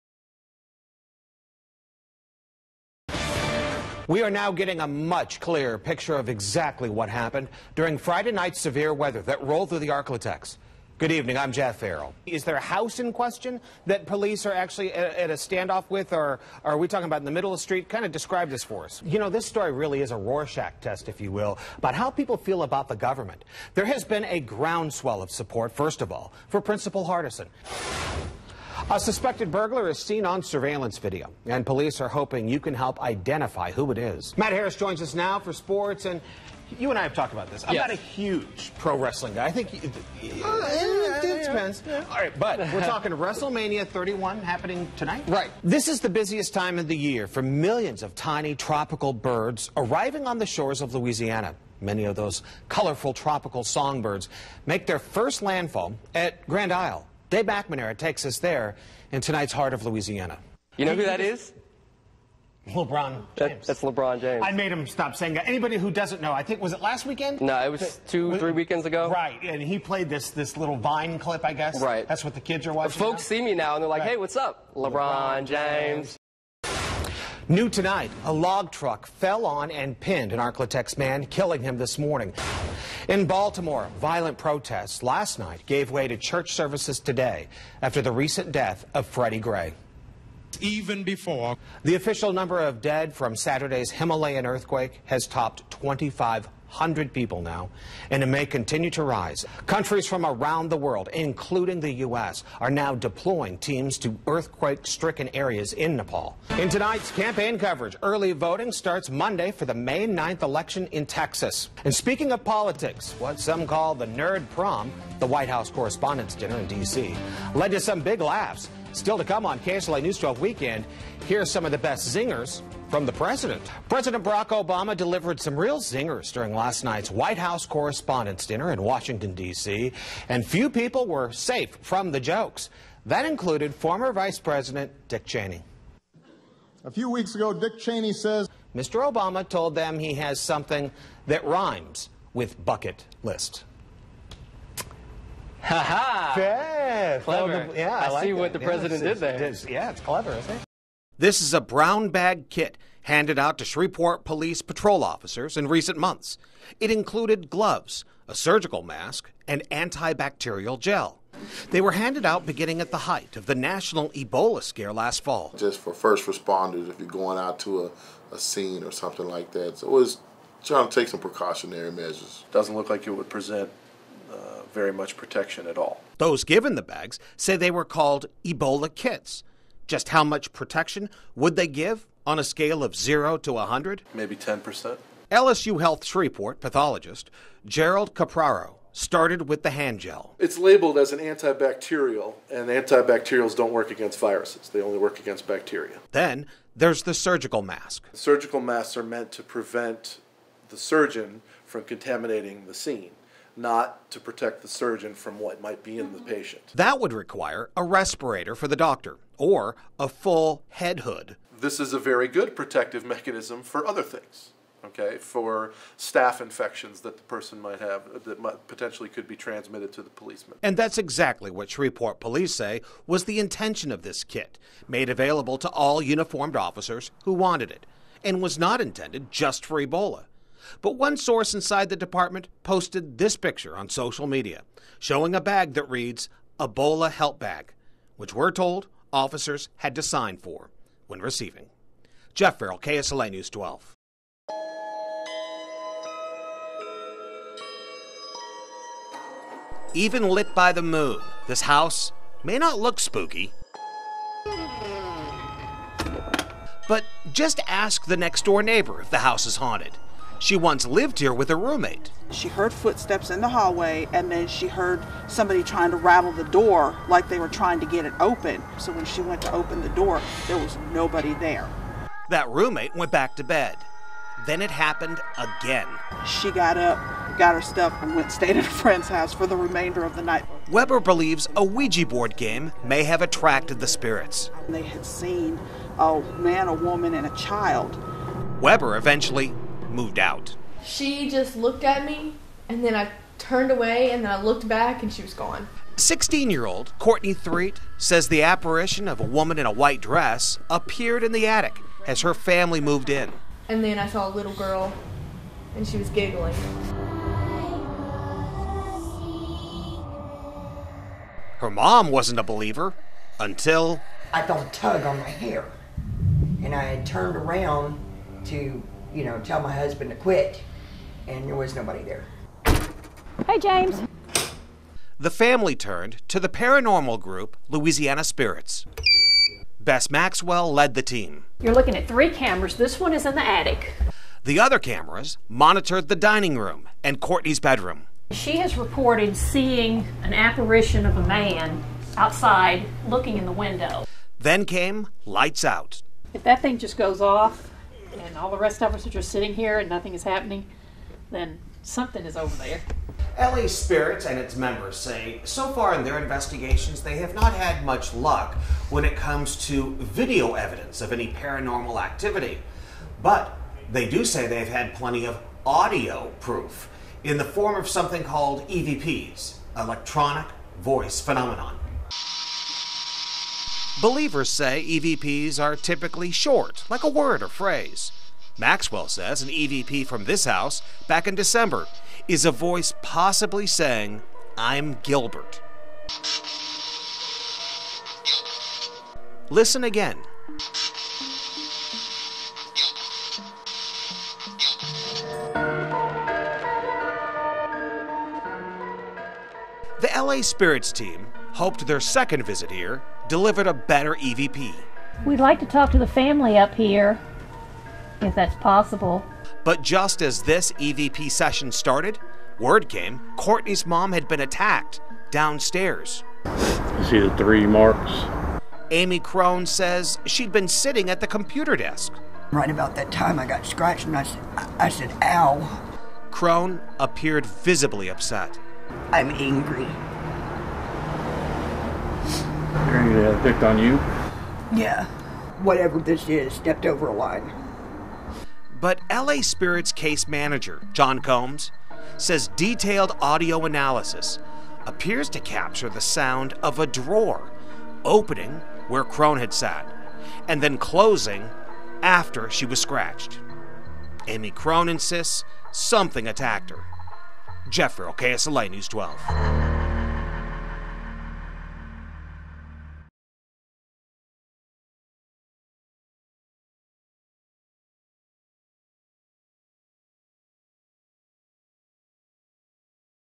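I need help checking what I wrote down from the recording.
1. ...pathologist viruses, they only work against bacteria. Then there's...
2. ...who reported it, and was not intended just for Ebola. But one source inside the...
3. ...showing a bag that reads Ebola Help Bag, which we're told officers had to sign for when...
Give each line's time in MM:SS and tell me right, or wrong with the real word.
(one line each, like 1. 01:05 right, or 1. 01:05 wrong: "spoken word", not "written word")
1. 03:13 wrong: "against", not "pathologist"
2. 03:47 wrong: "wanted", not "reported"
3. 03:54 right.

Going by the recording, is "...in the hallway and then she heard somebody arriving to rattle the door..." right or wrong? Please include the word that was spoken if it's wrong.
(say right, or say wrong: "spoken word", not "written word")
wrong: "trying", not "arriving".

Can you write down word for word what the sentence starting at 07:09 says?
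I'm angry going to dicked on you?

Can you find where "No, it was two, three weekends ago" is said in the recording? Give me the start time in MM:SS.
01:07.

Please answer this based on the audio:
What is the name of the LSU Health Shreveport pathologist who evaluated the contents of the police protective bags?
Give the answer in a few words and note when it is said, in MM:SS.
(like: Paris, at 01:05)
Gerald Capraro, at 03:07.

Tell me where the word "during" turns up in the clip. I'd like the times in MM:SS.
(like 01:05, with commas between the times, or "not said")
00:07, 02:06.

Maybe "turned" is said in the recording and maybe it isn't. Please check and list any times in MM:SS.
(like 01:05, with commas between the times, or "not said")
04:53, 05:17, 05:25.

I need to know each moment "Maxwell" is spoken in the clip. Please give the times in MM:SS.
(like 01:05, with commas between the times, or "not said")
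05:30, 06:18.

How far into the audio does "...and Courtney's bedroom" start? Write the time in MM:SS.
05:37.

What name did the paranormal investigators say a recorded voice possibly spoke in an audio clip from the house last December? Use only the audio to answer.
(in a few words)
Gilbert.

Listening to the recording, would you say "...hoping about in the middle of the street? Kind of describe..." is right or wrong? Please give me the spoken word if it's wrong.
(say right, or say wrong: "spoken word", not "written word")
wrong: "talking", not "hoping".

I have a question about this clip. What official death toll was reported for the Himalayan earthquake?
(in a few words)
2,500.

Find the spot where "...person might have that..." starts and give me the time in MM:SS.
03:37.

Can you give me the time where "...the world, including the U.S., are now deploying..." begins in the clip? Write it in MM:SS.
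01:40.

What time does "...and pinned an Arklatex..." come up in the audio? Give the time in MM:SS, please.
01:19.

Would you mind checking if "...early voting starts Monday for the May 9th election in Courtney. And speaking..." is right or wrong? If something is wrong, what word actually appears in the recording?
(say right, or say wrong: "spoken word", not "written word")
wrong: "Texas", not "Courtney".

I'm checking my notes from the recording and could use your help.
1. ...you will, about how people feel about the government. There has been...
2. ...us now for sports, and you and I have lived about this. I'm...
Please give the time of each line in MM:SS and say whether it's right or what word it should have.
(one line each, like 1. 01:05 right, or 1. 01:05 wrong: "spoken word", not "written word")
1. 00:21 right
2. 00:35 wrong: "talked", not "lived".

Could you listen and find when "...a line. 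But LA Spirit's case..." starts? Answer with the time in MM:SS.
07:17.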